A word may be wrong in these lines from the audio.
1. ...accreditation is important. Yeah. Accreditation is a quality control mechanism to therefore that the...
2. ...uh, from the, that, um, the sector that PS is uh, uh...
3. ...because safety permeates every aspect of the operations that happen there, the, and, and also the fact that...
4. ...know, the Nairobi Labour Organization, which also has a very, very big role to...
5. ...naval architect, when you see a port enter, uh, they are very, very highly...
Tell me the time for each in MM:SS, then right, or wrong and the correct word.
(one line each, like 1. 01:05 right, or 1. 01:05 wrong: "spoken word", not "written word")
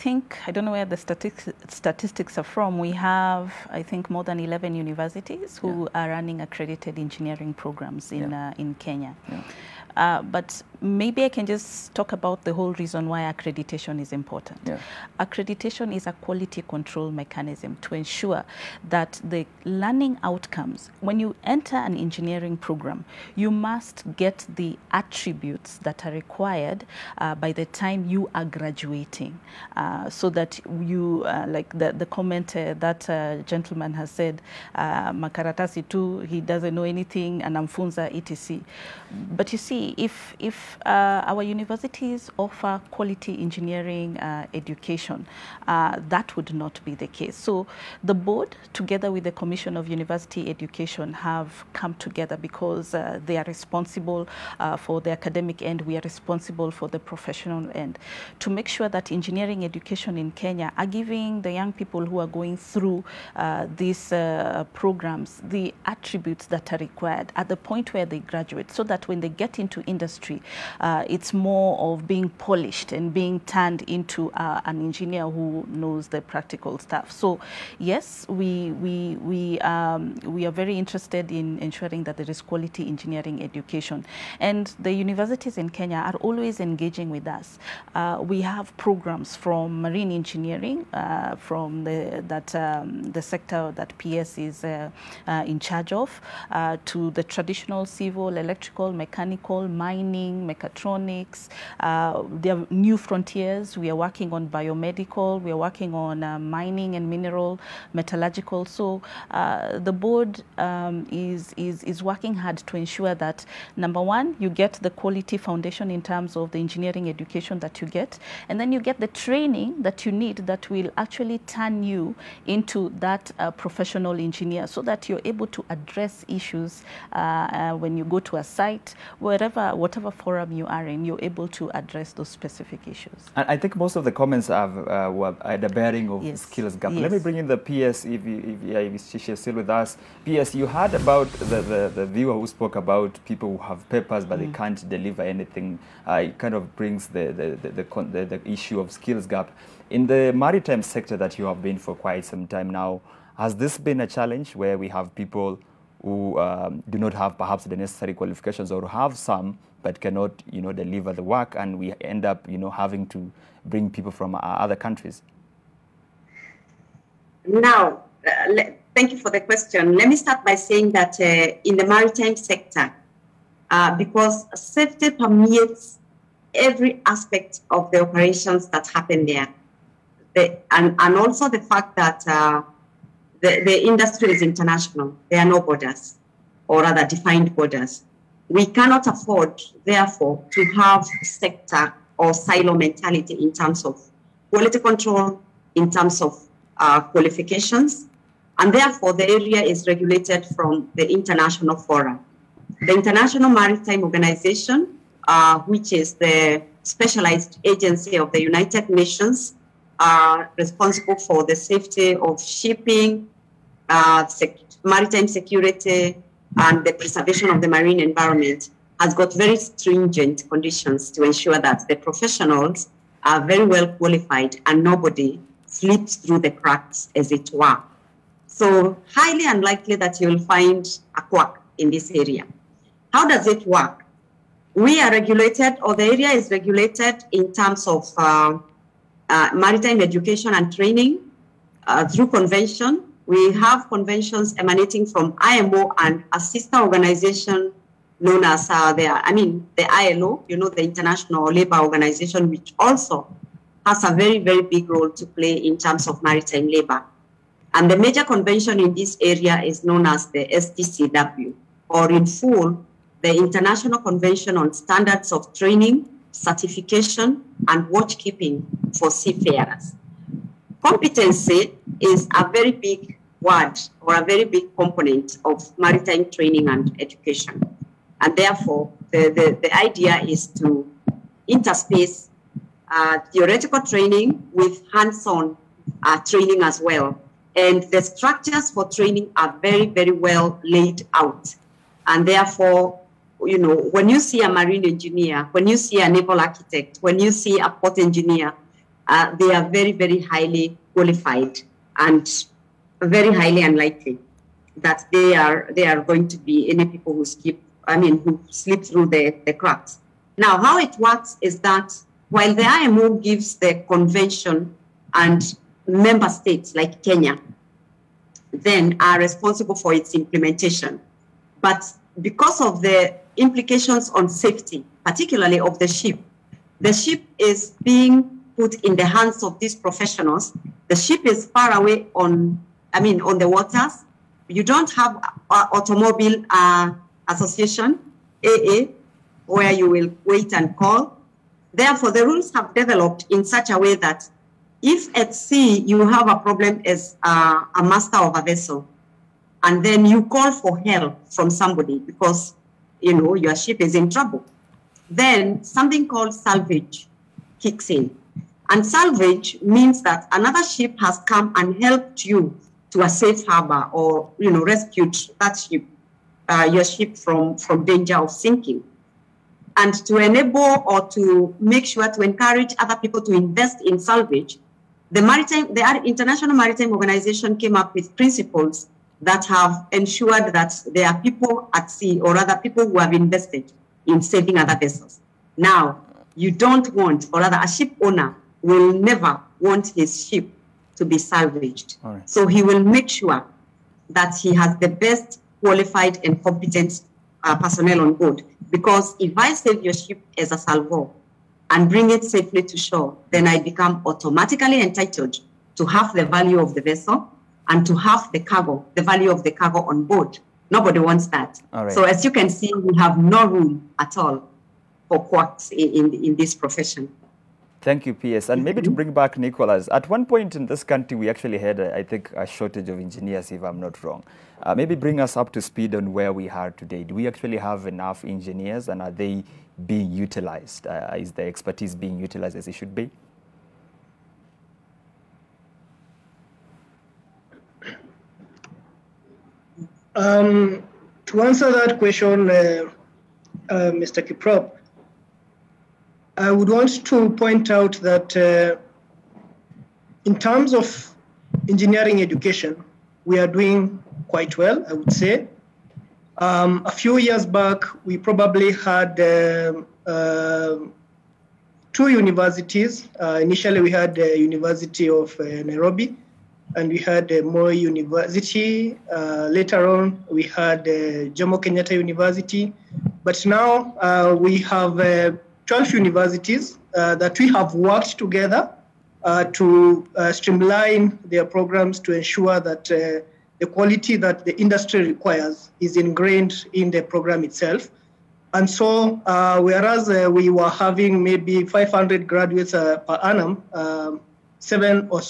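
1. 00:13 wrong: "ensure", not "therefore"
2. 01:30 right
3. 02:53 right
4. 04:10 wrong: "International", not "Nairobi"
5. 04:56 wrong: "engineer", not "enter".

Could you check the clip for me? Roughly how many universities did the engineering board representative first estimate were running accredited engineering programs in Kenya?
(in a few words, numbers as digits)
more than 11.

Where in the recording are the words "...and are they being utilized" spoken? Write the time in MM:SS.
07:08.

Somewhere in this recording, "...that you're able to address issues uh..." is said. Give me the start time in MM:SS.
02:04.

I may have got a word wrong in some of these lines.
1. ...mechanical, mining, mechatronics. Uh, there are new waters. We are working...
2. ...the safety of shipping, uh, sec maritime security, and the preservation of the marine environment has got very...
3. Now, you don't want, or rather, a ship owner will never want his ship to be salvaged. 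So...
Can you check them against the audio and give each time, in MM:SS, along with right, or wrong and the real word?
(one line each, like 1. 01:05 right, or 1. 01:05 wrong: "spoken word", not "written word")
1. 01:38 wrong: "frontiers", not "waters"
2. 03:31 right
3. 06:25 right.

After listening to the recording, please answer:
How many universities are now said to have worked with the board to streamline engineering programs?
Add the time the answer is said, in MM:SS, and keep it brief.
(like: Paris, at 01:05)
12, at 07:55.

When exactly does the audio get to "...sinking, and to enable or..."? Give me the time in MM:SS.
06:08.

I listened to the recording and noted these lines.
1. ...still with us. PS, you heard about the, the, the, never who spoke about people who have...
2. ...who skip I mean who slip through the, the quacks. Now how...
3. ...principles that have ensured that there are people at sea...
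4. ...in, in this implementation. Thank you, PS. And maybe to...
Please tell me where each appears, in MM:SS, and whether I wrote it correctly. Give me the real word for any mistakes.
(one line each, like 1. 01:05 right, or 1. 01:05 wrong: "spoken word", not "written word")
1. 02:19 wrong: "viewer", not "never"
2. 05:07 wrong: "cracks", not "quacks"
3. 06:18 right
4. 06:56 wrong: "profession", not "implementation".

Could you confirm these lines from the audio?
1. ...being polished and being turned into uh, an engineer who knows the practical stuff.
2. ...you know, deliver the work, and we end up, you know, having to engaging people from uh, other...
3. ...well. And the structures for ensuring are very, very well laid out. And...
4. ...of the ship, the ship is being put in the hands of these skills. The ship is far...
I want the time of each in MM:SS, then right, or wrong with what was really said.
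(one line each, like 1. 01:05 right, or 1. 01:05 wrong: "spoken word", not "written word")
1. 01:12 right
2. 02:40 wrong: "bring", not "engaging"
3. 04:46 wrong: "training", not "ensuring"
4. 05:25 wrong: "professionals", not "skills".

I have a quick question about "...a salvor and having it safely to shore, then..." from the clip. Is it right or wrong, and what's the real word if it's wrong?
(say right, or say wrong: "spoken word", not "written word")
wrong: "bring", not "having".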